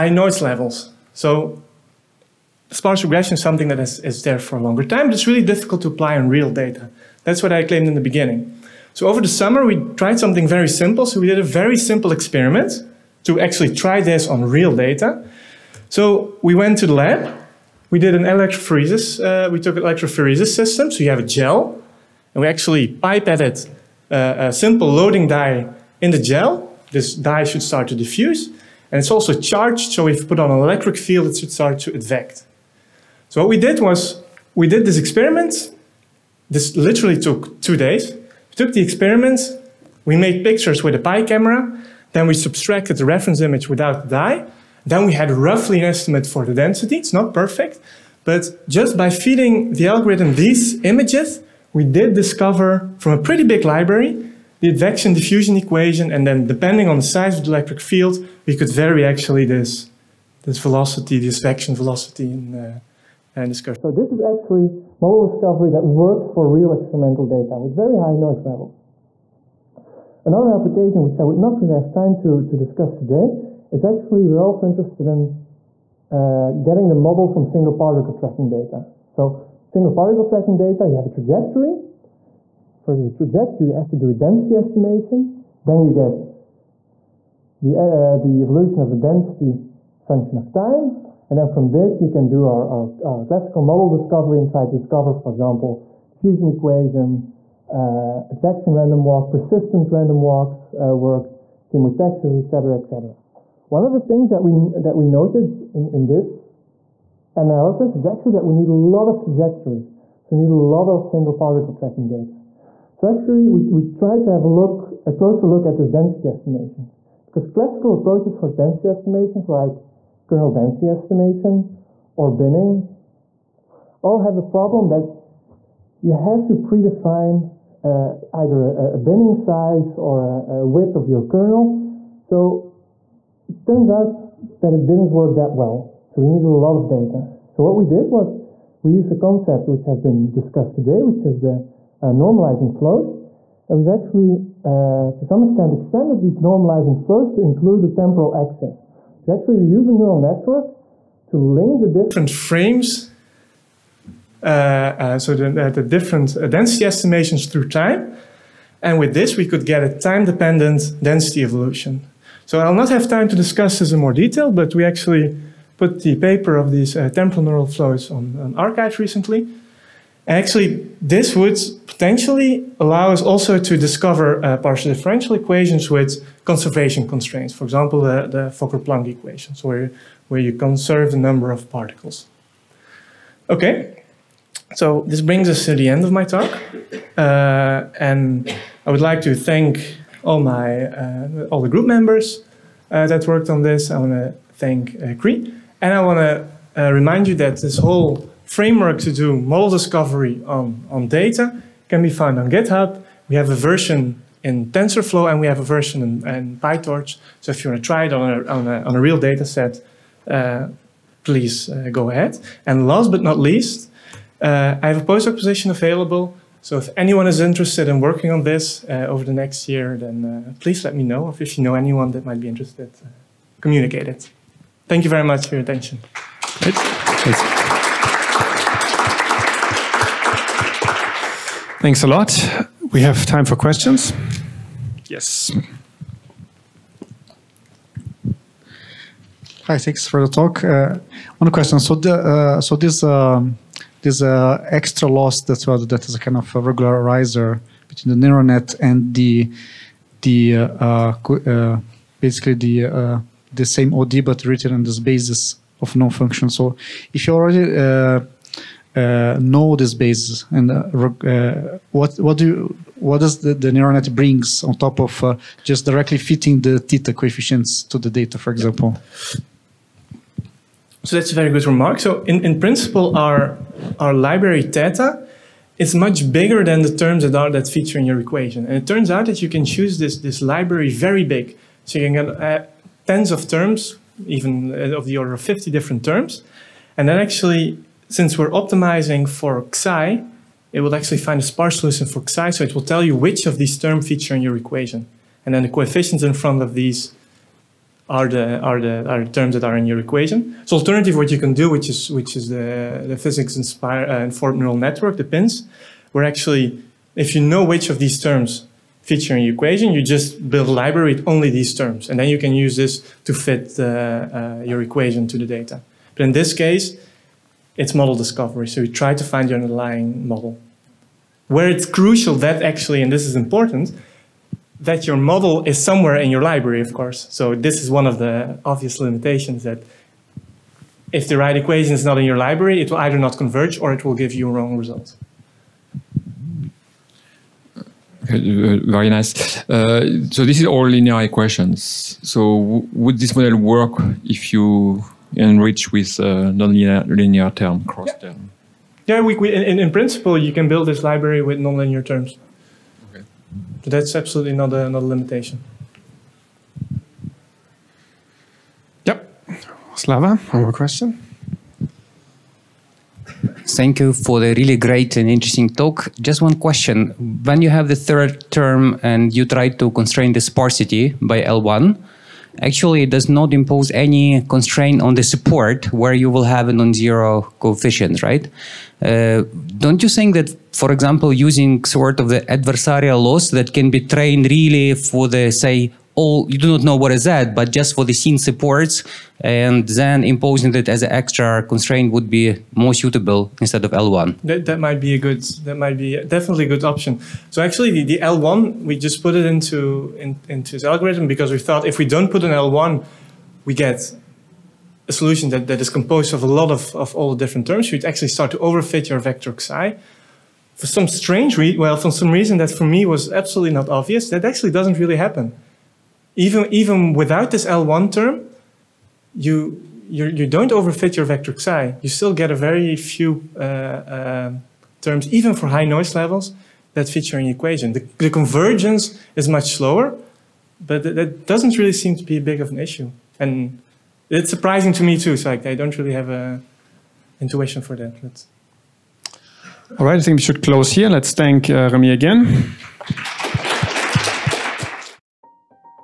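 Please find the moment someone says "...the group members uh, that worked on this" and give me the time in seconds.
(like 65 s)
191 s.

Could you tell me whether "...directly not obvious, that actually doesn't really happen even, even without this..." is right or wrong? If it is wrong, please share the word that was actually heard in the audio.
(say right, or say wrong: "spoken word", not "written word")
wrong: "absolutely", not "directly".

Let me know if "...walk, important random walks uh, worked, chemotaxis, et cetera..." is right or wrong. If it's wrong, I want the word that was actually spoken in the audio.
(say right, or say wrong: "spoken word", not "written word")
wrong: "persistent", not "important".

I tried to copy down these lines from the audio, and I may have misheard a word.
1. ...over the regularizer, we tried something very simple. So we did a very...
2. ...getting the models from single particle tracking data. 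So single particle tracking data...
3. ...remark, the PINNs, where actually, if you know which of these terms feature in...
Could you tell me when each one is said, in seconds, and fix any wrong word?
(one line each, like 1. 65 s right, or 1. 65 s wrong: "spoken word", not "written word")
1. 9 s wrong: "summer", not "regularizer"
2. 76 s right
3. 304 s wrong: "network", not "remark".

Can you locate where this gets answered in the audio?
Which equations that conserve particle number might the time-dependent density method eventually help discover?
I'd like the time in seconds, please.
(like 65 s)
178 s.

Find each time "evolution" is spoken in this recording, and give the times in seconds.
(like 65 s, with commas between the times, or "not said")
88 s, 161 s.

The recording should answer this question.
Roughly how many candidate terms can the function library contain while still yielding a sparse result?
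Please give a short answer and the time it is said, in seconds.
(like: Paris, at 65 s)
50, at 285 s.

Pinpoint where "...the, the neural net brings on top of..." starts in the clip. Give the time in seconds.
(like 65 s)
263 s.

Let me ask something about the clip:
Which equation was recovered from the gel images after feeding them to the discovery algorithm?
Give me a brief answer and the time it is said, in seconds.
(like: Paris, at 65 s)
advection diffusion equation, at 54 s.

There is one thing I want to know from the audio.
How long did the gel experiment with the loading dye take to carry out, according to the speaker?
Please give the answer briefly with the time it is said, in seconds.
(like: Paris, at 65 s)
2 days, at 37 s.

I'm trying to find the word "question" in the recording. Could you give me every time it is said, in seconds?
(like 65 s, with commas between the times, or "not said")
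233 s, 241 s, 360 s, 366 s.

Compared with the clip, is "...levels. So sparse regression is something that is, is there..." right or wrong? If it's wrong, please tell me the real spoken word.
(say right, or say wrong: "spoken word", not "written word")
right.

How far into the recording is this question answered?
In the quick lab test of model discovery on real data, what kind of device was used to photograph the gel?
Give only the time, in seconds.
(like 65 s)
40 s.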